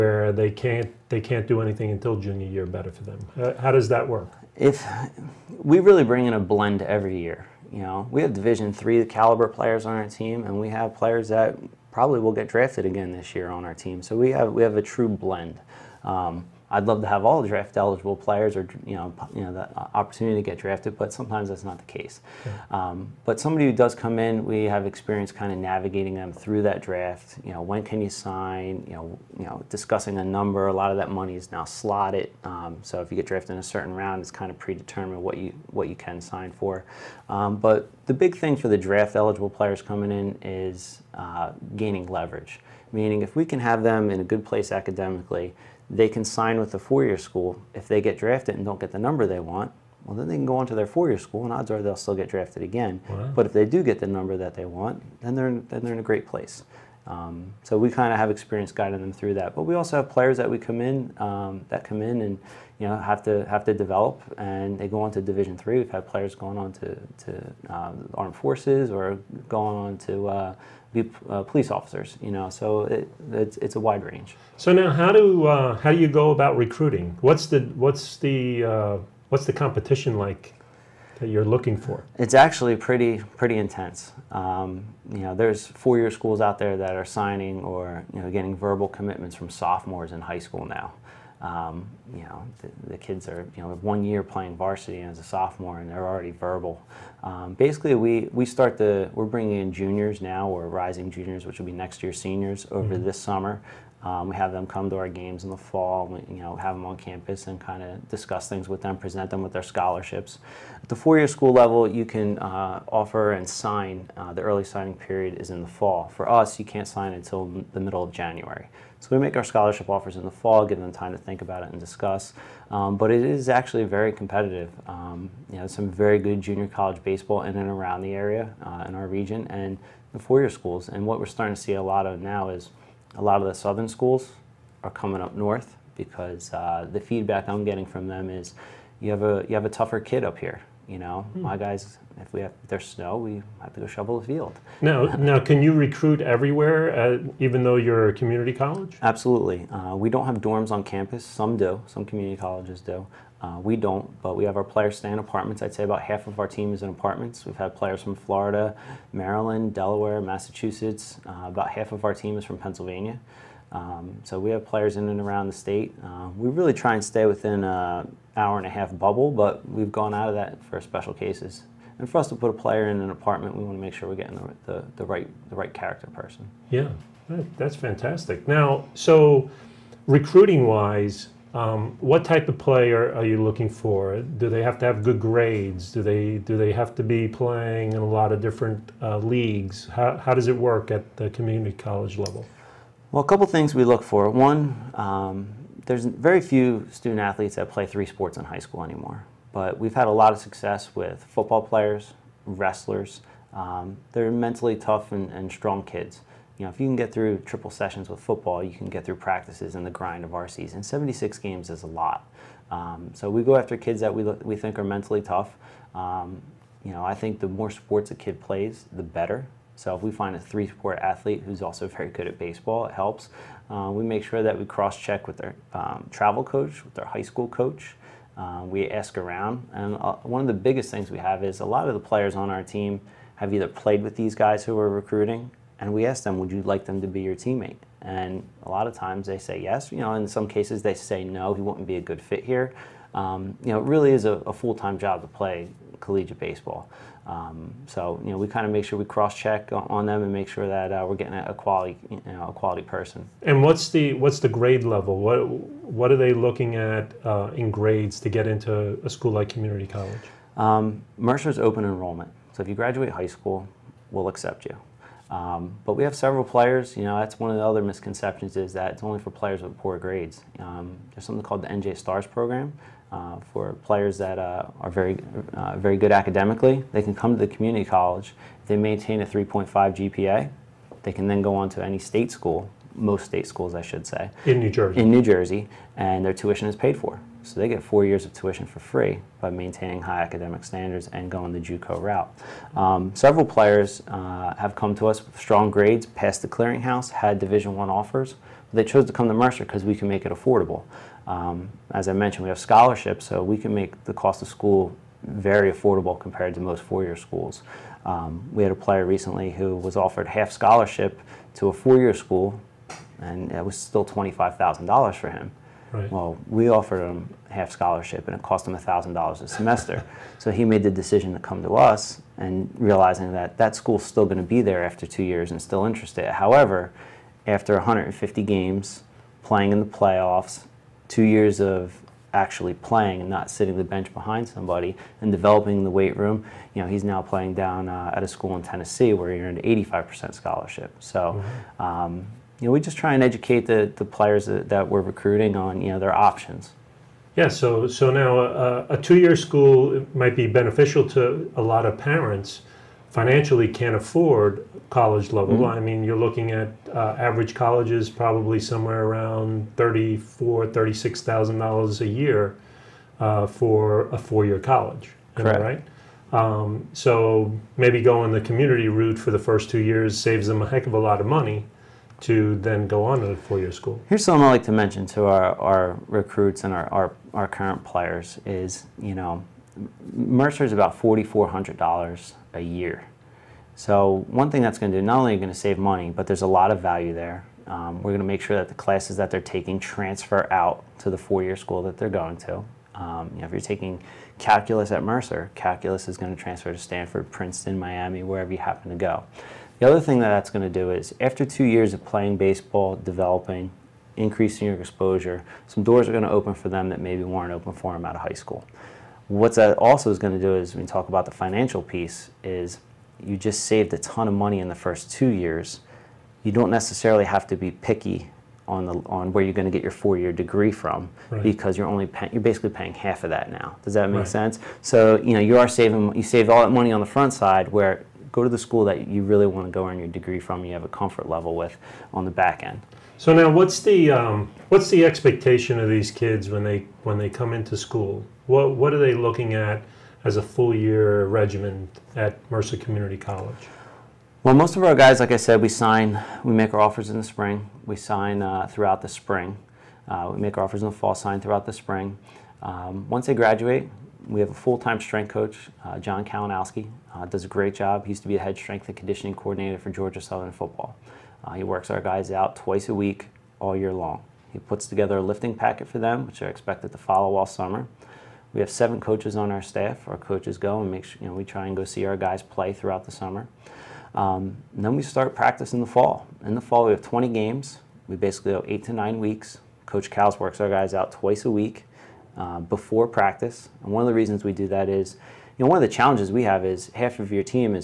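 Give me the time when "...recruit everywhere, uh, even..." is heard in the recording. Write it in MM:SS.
02:25.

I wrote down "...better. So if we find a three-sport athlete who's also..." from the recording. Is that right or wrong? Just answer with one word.
right.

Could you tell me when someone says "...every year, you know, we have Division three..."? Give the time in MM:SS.
00:06.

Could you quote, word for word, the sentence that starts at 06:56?
You don't necessarily have to be picky on the on where you're going to get your four-year degree from right.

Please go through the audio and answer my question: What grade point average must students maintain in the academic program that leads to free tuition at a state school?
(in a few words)
3.5.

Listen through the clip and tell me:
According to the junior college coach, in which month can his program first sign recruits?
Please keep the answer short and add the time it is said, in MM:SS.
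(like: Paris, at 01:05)
January, at 01:57.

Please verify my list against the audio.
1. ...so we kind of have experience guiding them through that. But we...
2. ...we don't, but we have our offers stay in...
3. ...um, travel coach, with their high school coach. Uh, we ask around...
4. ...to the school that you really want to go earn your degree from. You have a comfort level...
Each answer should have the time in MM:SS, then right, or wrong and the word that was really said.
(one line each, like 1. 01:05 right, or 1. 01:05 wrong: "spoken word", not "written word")
1. 00:57 right
2. 02:33 wrong: "players", not "offers"
3. 03:45 right
4. 07:08 right.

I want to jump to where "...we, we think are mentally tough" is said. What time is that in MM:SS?
03:34.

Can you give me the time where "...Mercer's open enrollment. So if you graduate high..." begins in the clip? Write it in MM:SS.
04:21.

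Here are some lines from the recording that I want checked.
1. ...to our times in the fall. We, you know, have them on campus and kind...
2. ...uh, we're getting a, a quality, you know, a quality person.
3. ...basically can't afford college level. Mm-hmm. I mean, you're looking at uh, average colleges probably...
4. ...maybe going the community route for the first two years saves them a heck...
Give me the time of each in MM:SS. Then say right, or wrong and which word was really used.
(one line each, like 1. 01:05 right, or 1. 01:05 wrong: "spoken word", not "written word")
1. 01:44 wrong: "games", not "times"
2. 04:10 right
3. 05:53 wrong: "financially", not "basically"
4. 06:07 right.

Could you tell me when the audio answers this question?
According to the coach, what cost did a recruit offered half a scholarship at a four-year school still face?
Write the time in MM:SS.
05:14.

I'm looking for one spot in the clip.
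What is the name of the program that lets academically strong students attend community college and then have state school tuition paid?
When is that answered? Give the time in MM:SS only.
04:31.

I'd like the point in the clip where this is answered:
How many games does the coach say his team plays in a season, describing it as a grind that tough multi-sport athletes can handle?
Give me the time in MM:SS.
03:30.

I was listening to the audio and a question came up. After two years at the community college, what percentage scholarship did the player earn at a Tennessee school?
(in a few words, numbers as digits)
85%.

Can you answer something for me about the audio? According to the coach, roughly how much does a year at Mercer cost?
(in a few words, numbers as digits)
$4,400.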